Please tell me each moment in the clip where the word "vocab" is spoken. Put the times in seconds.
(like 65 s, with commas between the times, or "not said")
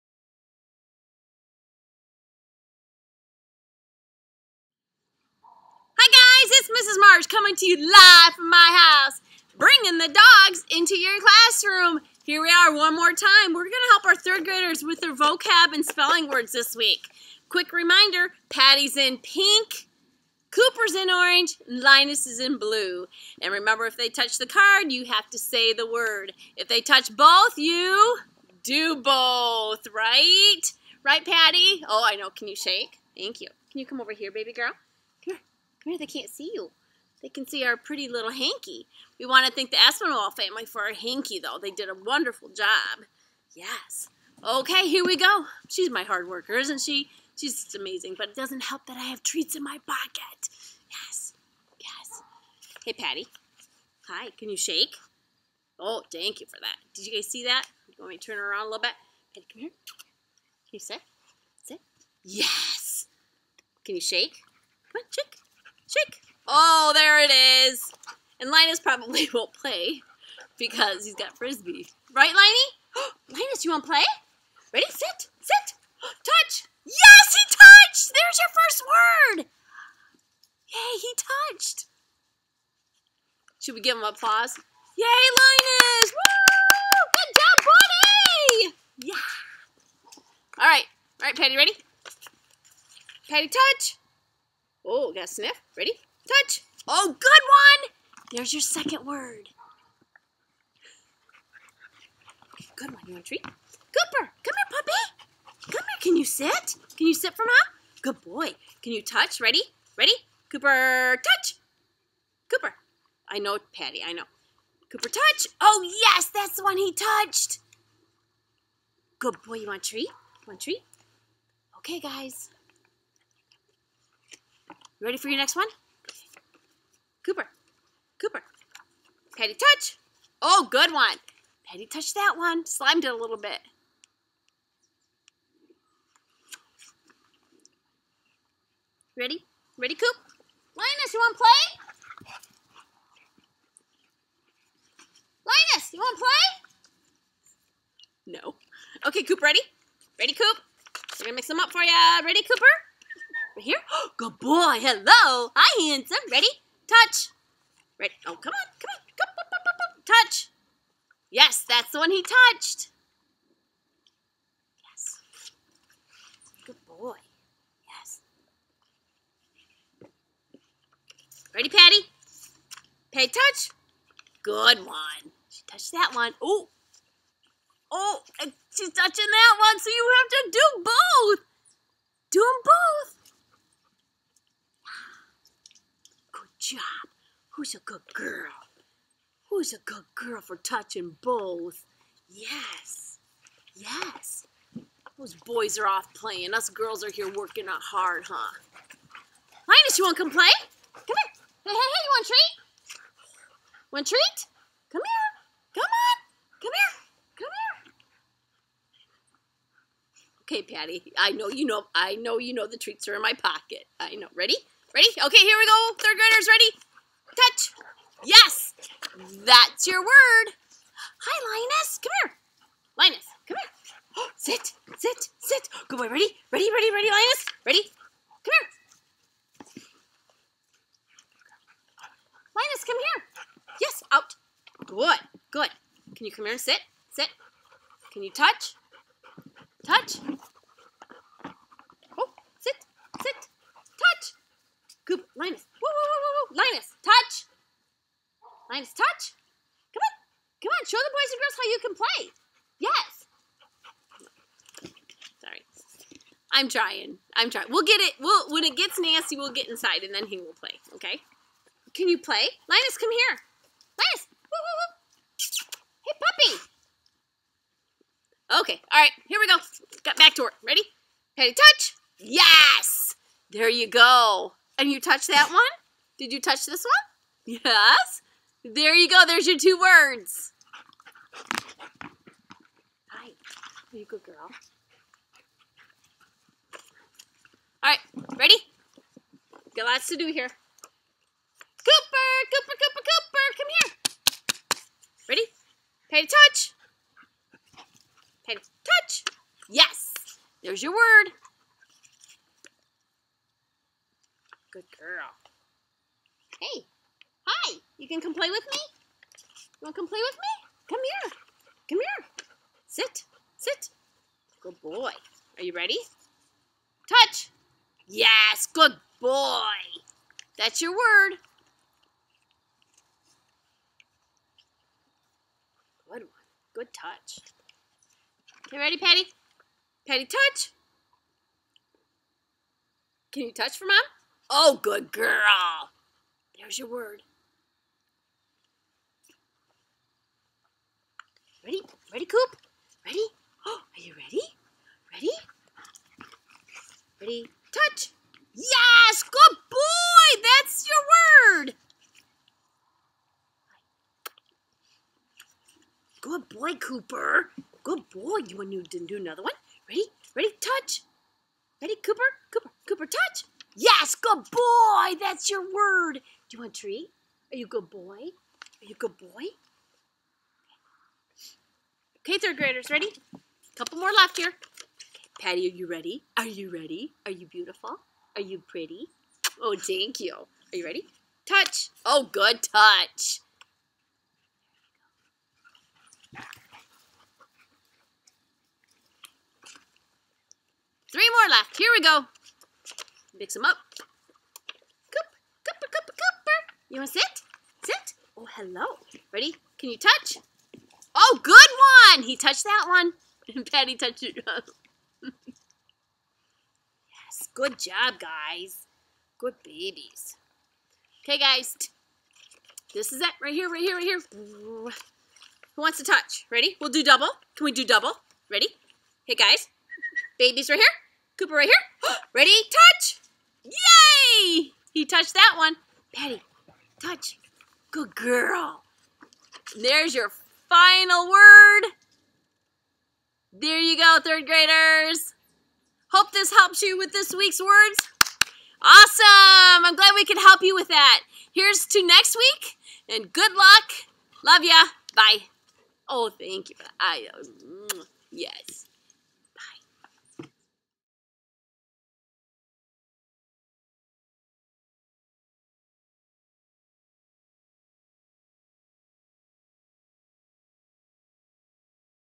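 15 s.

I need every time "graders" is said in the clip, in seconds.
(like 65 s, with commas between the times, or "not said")
14 s, 216 s, 372 s, 434 s.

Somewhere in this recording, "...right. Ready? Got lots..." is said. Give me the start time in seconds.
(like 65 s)
287 s.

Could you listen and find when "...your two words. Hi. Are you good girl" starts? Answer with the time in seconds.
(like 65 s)
279 s.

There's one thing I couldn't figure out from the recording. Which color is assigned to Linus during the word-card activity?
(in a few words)
Blue.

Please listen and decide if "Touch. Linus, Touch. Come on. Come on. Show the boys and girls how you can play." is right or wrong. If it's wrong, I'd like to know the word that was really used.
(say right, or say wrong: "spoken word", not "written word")
right.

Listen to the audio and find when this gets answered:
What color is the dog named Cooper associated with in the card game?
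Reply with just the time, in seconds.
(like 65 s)
21 s.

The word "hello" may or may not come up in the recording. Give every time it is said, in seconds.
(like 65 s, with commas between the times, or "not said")
154 s, 398 s.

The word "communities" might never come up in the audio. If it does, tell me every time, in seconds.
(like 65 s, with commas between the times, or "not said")
not said.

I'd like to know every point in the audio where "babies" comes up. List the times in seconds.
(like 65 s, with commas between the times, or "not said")
409 s, 420 s.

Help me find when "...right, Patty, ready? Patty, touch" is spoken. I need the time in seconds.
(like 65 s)
91 s.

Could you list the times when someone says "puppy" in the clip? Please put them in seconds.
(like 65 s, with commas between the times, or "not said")
104 s, 266 s.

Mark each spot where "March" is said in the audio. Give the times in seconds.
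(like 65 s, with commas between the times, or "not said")
6 s.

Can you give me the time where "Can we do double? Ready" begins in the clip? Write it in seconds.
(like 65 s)
417 s.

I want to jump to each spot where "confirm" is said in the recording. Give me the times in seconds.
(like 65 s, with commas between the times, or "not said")
not said.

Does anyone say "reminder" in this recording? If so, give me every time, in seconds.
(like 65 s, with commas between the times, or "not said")
17 s.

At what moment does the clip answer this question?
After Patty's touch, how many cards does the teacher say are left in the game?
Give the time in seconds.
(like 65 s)
391 s.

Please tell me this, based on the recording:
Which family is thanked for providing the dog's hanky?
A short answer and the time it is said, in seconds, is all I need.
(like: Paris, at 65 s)
Espinal, at 39 s.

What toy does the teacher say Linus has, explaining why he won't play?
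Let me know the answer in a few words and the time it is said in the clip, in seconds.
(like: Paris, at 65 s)
Frisbee, at 71 s.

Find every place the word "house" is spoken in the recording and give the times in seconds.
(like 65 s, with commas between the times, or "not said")
9 s.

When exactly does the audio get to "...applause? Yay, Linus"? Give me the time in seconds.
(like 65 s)
84 s.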